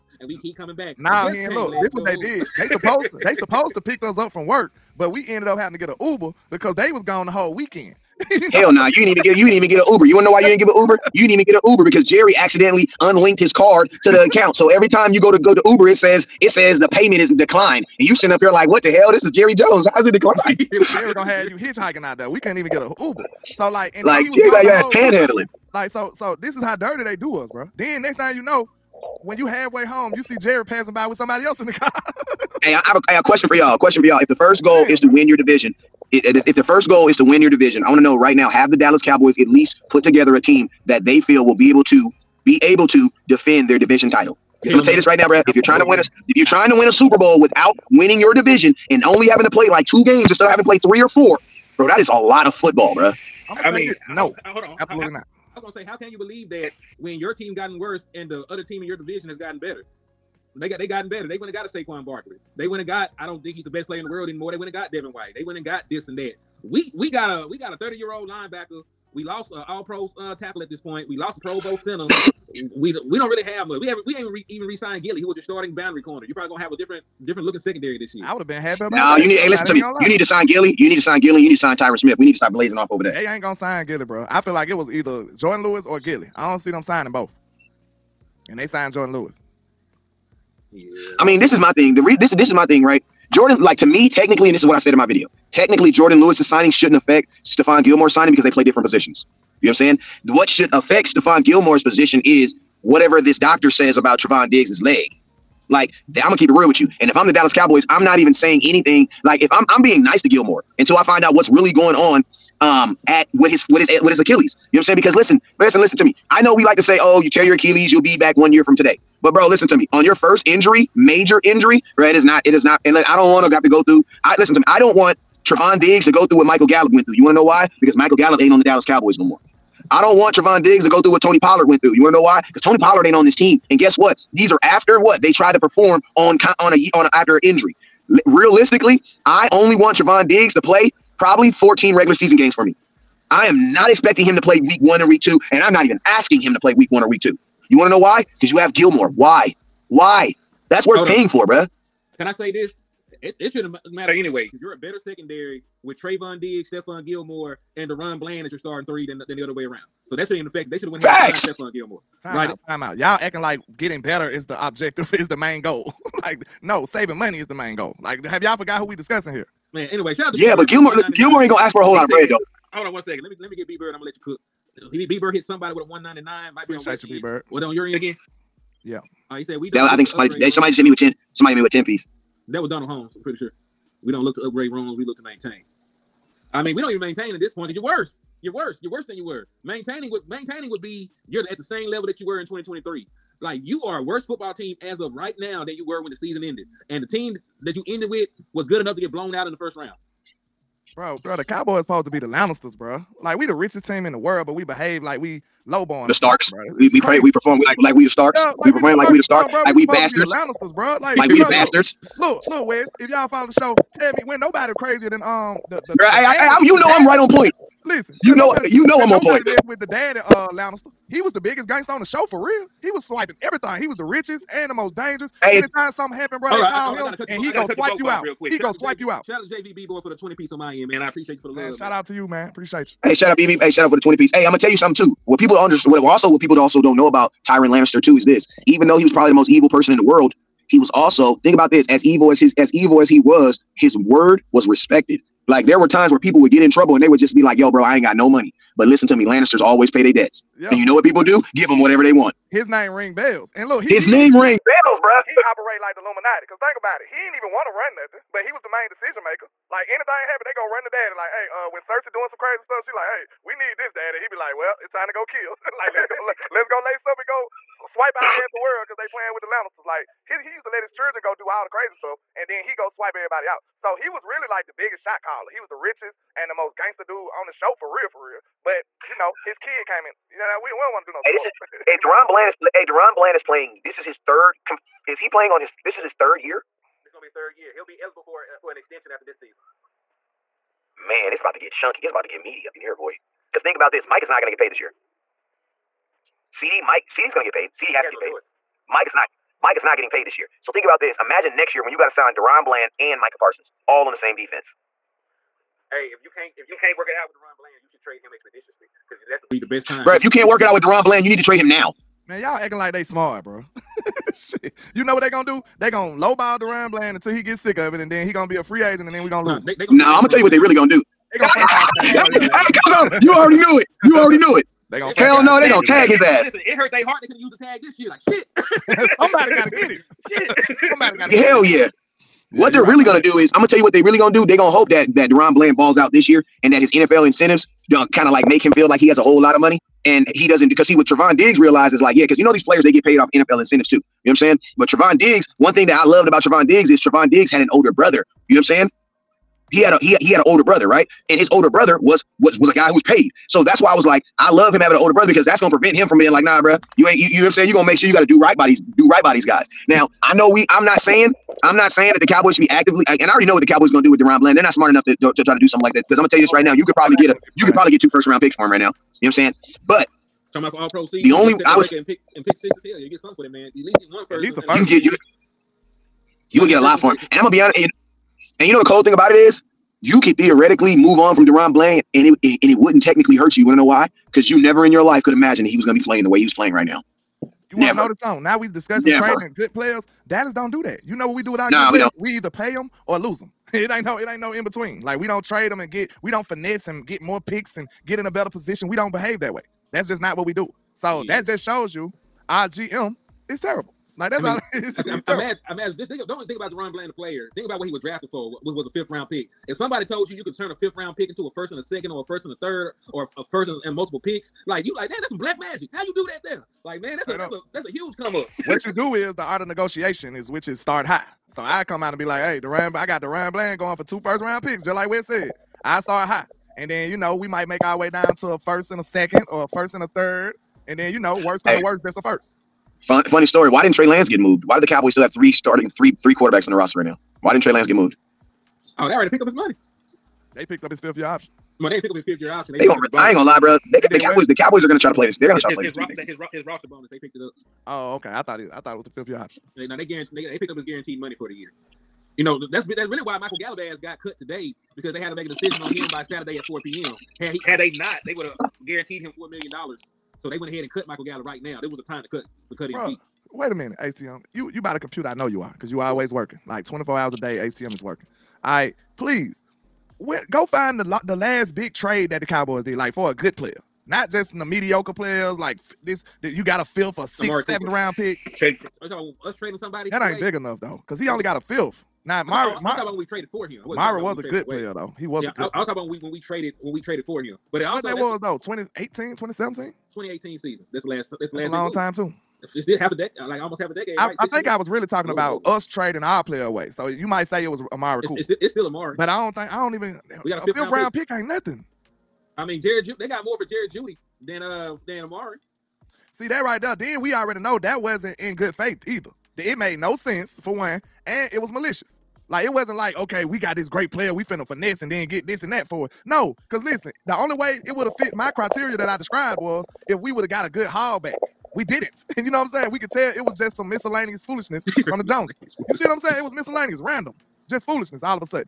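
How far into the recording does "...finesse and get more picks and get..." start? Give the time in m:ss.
6:36.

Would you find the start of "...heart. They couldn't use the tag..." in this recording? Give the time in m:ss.
5:27.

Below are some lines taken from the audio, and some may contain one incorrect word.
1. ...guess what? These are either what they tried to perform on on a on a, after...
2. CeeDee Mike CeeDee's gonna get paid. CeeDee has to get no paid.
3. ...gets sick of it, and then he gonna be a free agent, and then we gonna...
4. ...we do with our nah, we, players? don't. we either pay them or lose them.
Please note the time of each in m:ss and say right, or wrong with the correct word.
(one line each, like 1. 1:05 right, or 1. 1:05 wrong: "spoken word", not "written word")
1. 2:13 wrong: "after", not "either"
2. 4:56 right
3. 5:17 right
4. 6:31 right.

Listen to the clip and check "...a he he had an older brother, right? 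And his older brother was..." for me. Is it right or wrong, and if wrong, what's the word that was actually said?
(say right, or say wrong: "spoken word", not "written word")
right.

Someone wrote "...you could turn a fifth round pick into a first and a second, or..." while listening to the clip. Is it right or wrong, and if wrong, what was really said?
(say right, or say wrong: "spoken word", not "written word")
right.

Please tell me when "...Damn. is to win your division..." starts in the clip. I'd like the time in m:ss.
0:34.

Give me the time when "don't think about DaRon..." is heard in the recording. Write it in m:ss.
6:46.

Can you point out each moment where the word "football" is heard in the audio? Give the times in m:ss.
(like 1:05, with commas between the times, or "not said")
0:52, 3:14.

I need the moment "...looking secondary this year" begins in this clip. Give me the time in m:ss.
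1:17.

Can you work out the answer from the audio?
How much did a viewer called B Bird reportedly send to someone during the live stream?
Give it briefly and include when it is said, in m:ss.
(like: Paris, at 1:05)
199, at 2:55.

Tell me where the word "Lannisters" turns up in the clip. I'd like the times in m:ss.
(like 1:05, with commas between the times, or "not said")
3:22, 3:30, 3:40, 3:57, 4:09, 4:29.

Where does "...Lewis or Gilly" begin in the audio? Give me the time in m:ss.
1:25.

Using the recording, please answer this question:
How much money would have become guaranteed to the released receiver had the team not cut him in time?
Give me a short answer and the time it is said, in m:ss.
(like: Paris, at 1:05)
4 million dollars, at 7:39.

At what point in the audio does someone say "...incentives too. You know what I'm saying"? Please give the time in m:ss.
5:43.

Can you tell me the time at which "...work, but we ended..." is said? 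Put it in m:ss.
0:04.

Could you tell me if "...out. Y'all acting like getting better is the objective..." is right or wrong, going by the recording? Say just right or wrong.
right.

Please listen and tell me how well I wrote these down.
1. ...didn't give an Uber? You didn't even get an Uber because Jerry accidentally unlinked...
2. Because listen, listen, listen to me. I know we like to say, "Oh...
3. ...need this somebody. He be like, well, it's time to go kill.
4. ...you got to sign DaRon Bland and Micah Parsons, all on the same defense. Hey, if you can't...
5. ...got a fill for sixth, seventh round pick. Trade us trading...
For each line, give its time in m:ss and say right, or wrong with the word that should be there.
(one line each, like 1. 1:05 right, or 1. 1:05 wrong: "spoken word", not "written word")
1. 0:10 right
2. 1:54 right
3. 4:23 wrong: "daddy", not "somebody"
4. 5:01 right
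5. 7:56 right.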